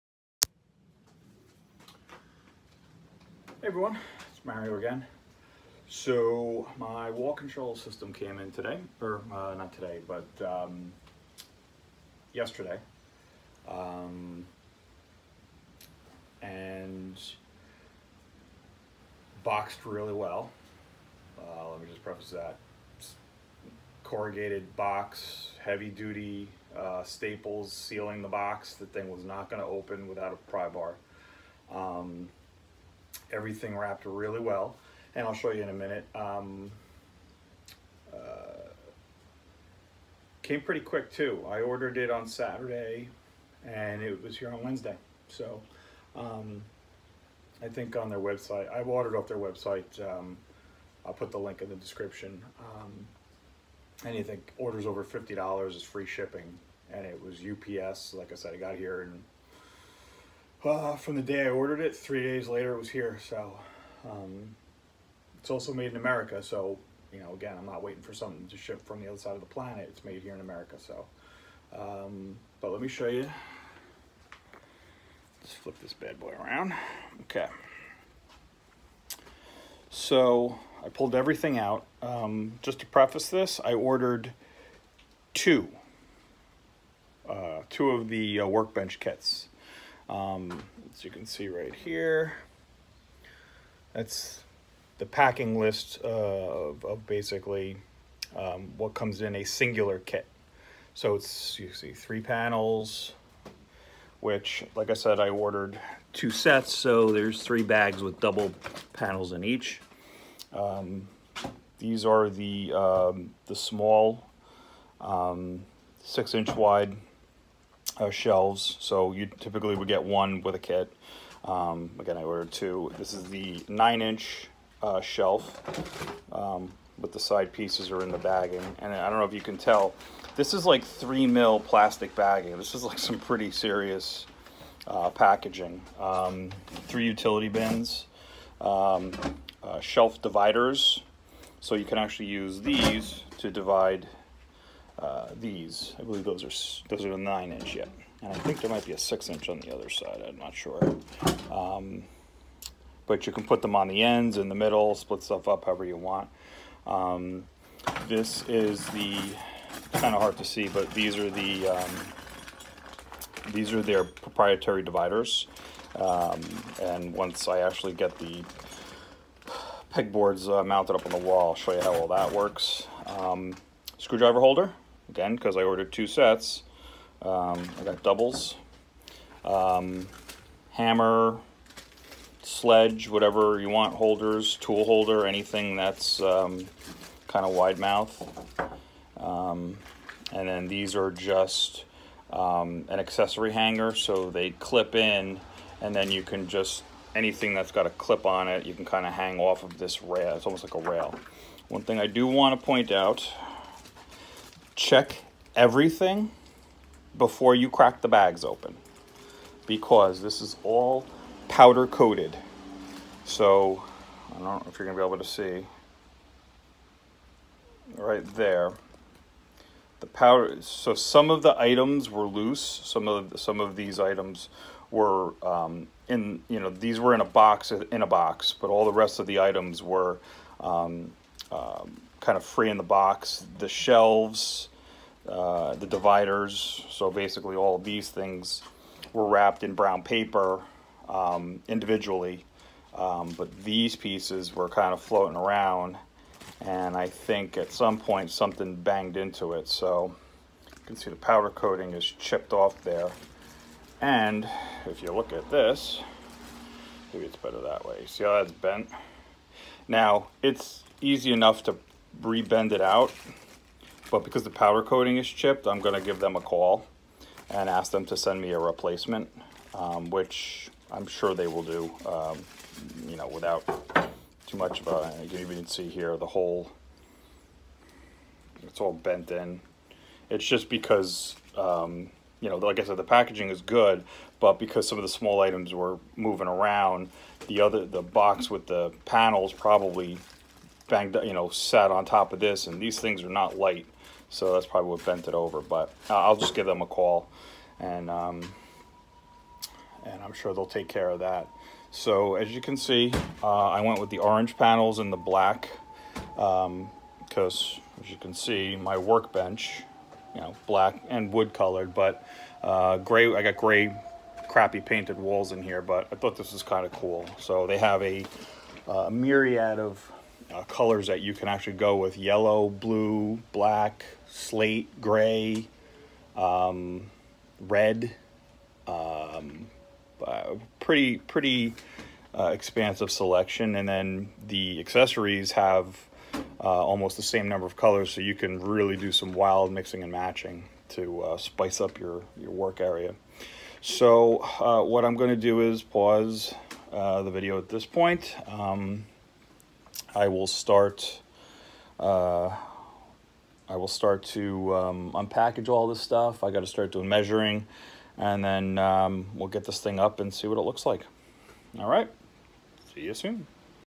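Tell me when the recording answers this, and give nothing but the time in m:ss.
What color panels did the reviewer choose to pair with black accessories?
5:04.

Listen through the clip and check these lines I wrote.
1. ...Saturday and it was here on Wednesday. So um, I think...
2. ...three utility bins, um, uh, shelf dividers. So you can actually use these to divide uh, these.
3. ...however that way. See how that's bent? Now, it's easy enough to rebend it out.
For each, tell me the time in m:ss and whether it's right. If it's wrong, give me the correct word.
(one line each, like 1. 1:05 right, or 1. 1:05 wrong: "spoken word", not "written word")
1. 0:42 right
2. 2:16 right
3. 4:17 wrong: "better", not "however".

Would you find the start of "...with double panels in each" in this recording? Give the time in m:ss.
1:48.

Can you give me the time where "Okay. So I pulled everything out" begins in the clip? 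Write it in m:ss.
1:17.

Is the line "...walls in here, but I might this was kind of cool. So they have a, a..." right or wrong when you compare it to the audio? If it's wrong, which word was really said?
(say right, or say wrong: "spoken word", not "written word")
wrong: "thought", not "might".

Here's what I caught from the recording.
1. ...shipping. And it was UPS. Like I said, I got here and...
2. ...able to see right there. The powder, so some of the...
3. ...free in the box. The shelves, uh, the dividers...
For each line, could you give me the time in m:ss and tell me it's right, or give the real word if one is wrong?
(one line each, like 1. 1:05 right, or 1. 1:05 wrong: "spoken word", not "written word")
1. 0:56 right
2. 3:35 right
3. 3:52 right.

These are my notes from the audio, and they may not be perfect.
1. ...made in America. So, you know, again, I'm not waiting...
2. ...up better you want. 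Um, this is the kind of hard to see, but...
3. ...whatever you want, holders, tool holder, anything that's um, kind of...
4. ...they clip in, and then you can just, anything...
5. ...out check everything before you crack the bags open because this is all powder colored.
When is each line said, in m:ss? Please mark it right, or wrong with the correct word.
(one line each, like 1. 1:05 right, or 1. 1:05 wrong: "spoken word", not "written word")
1. 1:05 right
2. 2:35 wrong: "however", not "better"
3. 3:03 right
4. 3:14 right
5. 3:22 wrong: "coated", not "colored".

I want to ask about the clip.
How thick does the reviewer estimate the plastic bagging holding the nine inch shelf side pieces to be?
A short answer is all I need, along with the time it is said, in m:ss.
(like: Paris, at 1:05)
3 mil, at 2:10.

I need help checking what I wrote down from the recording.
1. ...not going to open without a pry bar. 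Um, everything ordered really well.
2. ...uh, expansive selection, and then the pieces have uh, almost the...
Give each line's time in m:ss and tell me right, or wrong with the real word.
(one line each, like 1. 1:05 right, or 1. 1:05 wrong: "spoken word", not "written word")
1. 0:29 wrong: "wrapped", not "ordered"
2. 5:32 wrong: "accessories", not "pieces".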